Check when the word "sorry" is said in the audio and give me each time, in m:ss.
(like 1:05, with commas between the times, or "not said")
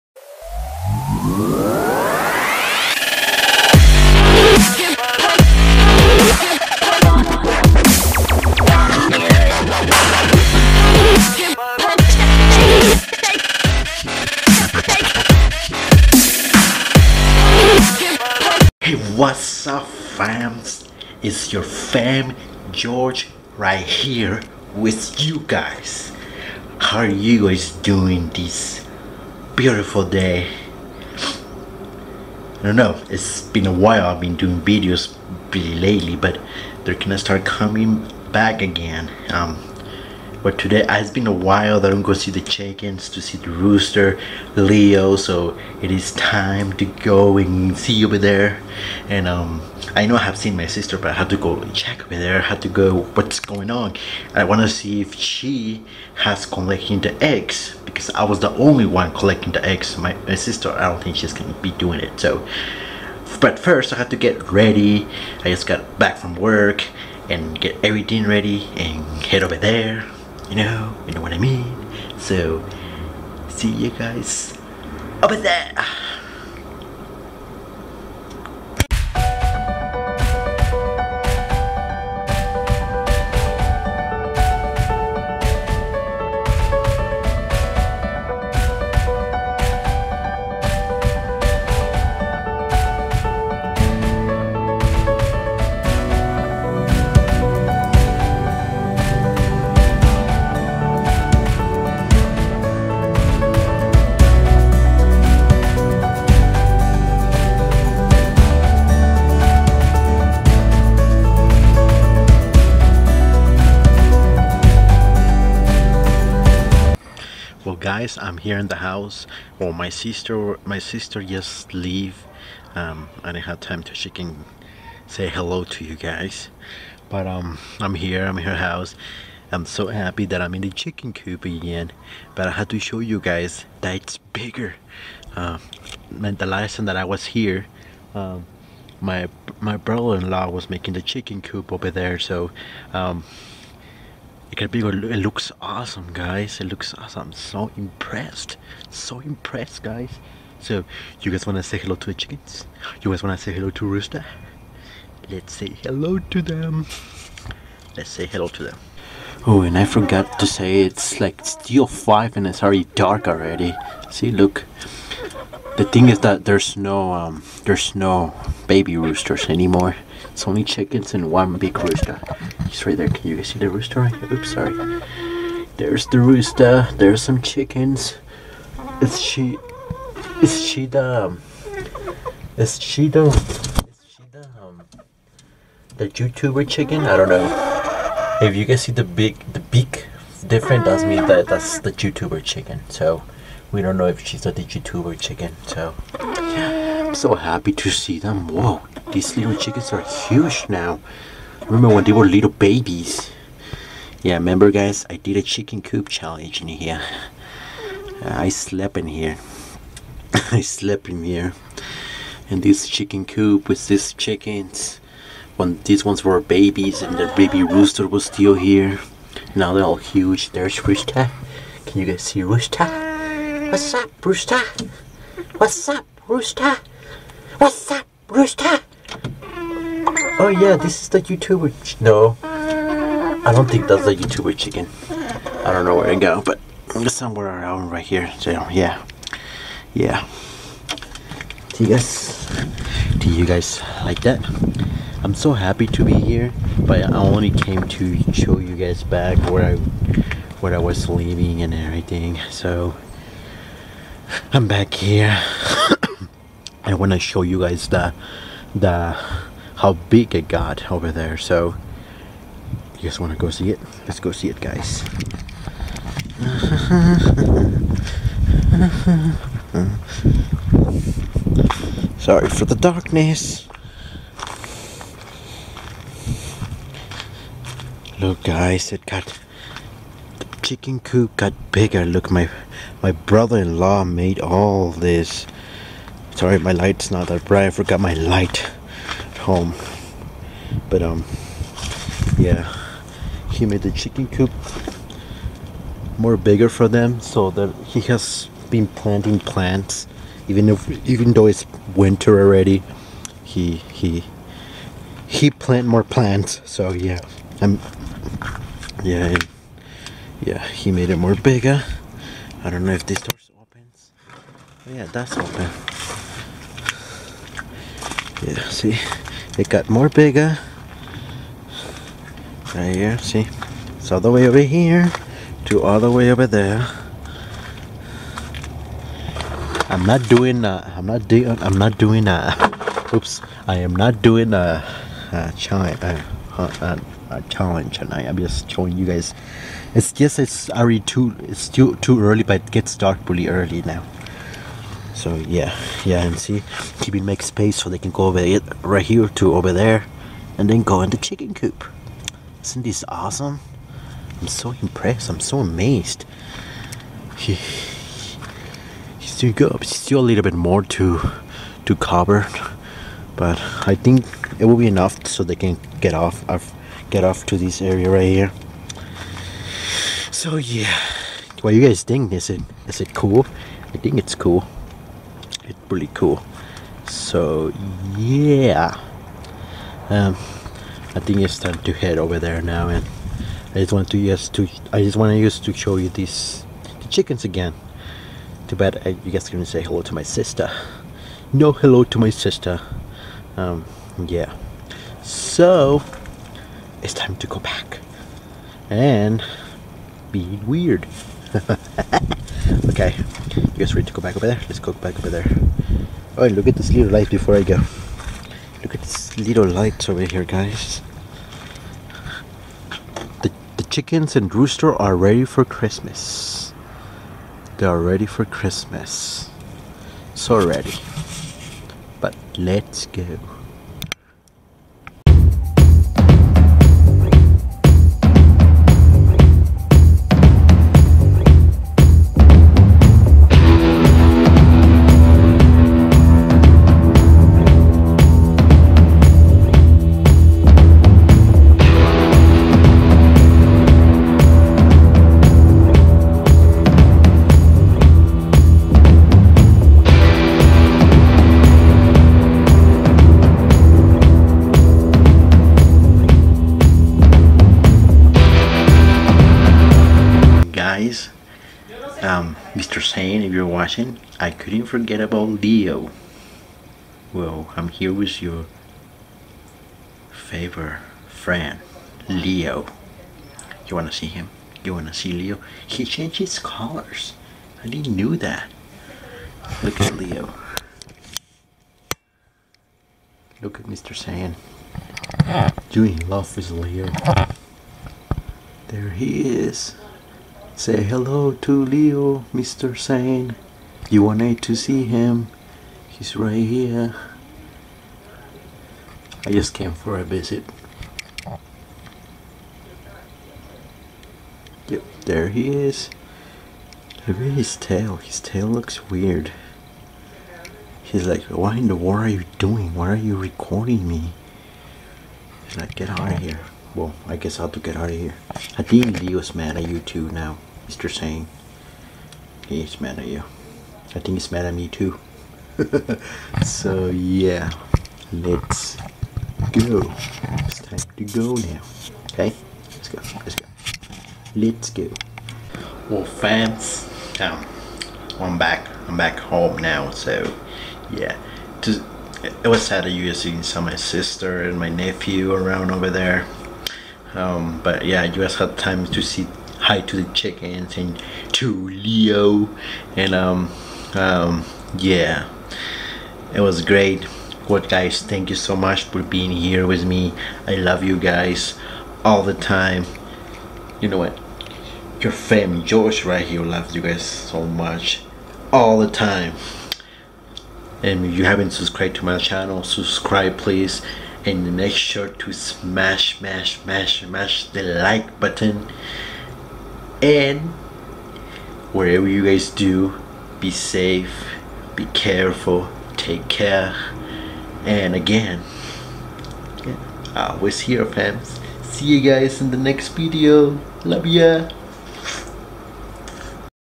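2:54, 4:32, 4:46.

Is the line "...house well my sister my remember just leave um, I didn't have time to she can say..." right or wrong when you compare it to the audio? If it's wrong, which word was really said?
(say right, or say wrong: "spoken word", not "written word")
wrong: "sister", not "remember".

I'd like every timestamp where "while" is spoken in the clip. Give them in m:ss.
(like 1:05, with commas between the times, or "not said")
0:33, 0:41.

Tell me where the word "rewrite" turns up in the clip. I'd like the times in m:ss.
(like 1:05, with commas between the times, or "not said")
not said.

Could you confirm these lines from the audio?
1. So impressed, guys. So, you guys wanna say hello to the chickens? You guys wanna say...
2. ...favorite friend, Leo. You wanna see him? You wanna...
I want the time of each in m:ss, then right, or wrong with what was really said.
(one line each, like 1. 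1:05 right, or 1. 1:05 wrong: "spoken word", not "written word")
1. 2:28 right
2. 7:50 right.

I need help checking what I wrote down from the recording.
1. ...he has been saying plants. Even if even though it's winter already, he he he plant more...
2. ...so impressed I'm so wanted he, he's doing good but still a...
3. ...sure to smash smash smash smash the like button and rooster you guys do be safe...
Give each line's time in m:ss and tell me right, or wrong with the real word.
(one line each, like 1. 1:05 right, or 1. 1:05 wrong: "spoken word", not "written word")
1. 4:57 wrong: "planting", not "saying"
2. 5:54 wrong: "amazed", not "wanted"
3. 9:34 wrong: "wherever", not "rooster".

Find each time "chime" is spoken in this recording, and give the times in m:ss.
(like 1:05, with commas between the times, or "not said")
5:35.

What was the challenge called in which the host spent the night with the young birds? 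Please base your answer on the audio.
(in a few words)
chicken coop challenge.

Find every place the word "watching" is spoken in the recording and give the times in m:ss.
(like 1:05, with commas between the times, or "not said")
7:43.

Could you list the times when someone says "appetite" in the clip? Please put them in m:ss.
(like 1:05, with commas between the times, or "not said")
not said.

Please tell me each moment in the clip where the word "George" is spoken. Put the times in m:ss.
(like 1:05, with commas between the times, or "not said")
0:22, 9:25.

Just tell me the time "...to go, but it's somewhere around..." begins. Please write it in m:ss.
3:56.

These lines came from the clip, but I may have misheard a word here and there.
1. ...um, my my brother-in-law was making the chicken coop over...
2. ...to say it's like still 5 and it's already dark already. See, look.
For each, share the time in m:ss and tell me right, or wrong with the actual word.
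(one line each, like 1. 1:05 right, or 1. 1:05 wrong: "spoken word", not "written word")
1. 2:18 right
2. 2:40 right.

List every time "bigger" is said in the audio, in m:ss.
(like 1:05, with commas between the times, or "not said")
2:14, 4:41, 4:56, 5:11, 5:20.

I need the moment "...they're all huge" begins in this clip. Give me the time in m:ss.
3:39.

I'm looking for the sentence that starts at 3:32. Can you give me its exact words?
And this chicken coop with these chickens.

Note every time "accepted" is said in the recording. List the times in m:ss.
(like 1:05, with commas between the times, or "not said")
not said.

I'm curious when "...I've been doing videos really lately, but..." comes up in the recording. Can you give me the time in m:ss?
0:34.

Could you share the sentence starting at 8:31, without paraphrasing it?
He's like, why in the world are you doing?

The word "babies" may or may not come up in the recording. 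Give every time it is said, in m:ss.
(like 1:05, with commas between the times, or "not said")
3:22, 3:36.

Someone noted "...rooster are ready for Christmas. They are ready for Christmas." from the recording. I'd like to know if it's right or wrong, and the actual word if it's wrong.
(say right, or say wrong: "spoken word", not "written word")
right.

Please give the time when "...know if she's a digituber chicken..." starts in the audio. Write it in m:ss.
3:13.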